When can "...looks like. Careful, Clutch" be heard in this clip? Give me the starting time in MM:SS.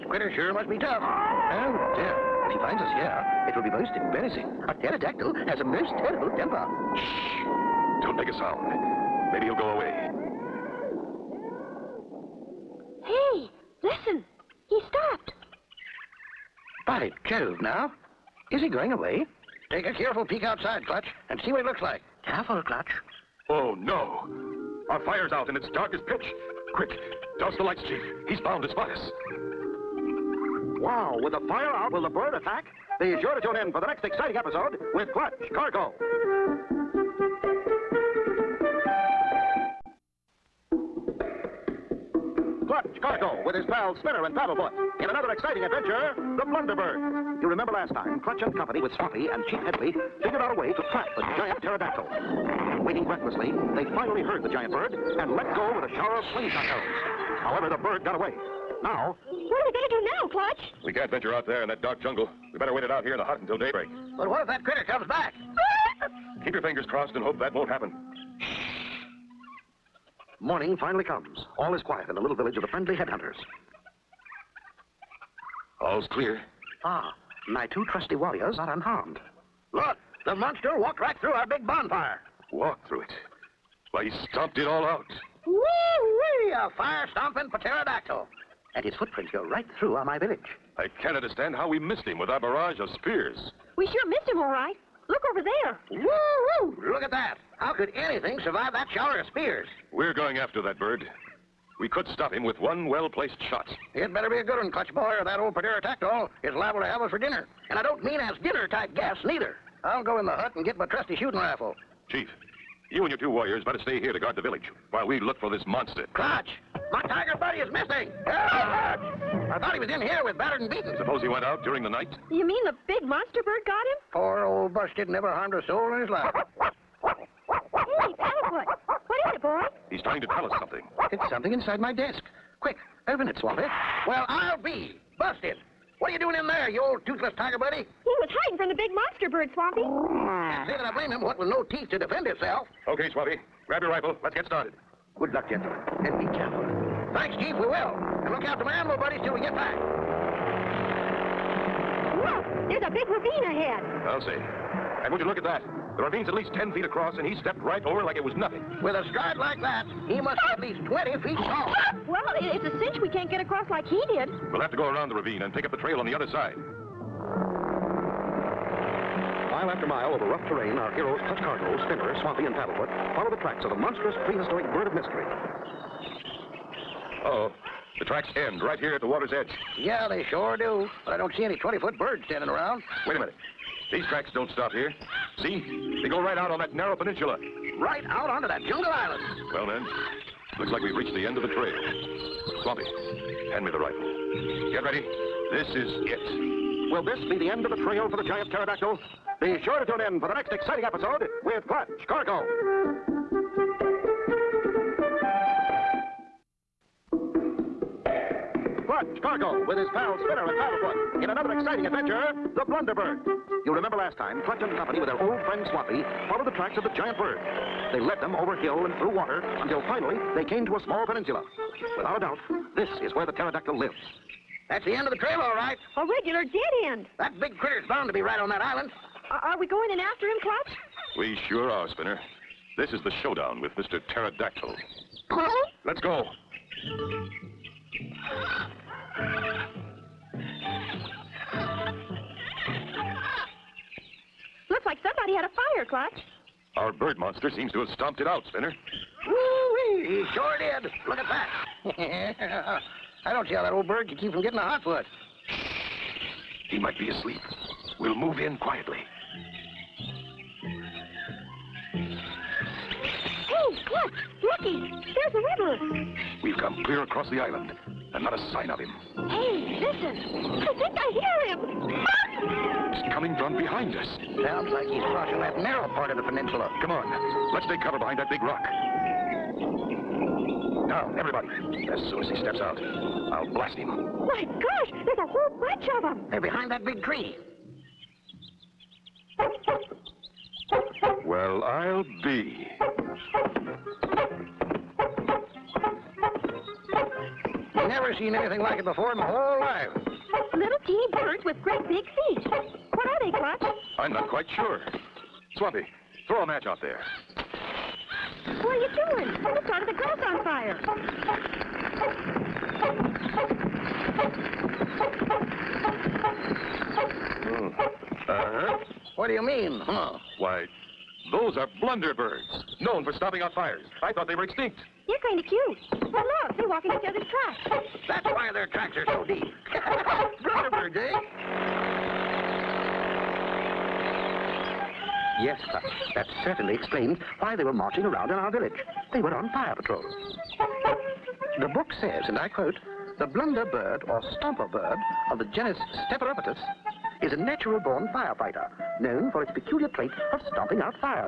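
00:21.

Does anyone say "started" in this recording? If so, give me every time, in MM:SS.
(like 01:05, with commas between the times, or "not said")
02:24, 05:09.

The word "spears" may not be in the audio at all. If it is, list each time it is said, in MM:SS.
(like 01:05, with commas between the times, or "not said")
01:32, 01:39.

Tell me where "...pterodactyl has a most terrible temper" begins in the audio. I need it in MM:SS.
00:04.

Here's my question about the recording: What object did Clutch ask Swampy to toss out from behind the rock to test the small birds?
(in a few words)
A match.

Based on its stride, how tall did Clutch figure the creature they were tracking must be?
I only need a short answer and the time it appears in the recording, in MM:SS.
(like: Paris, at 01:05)
20 feet, at 02:40.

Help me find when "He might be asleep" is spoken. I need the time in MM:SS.
04:16.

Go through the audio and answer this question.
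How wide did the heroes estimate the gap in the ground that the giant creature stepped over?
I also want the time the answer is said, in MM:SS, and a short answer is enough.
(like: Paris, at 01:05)
10 feet, at 02:36.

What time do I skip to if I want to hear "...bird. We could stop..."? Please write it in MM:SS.
01:40.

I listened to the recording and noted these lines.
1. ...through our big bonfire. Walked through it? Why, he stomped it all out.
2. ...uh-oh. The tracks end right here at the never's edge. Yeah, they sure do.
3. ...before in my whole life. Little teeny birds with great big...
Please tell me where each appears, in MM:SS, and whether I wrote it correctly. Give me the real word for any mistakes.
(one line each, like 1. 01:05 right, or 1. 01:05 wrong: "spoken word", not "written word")
1. 01:21 right
2. 02:57 wrong: "water", not "never"
3. 04:58 right.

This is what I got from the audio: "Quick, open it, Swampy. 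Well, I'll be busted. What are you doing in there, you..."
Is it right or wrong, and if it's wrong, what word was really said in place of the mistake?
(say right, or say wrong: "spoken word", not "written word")
right.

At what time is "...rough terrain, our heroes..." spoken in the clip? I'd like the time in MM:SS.
02:50.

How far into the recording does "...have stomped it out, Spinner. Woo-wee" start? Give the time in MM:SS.
04:07.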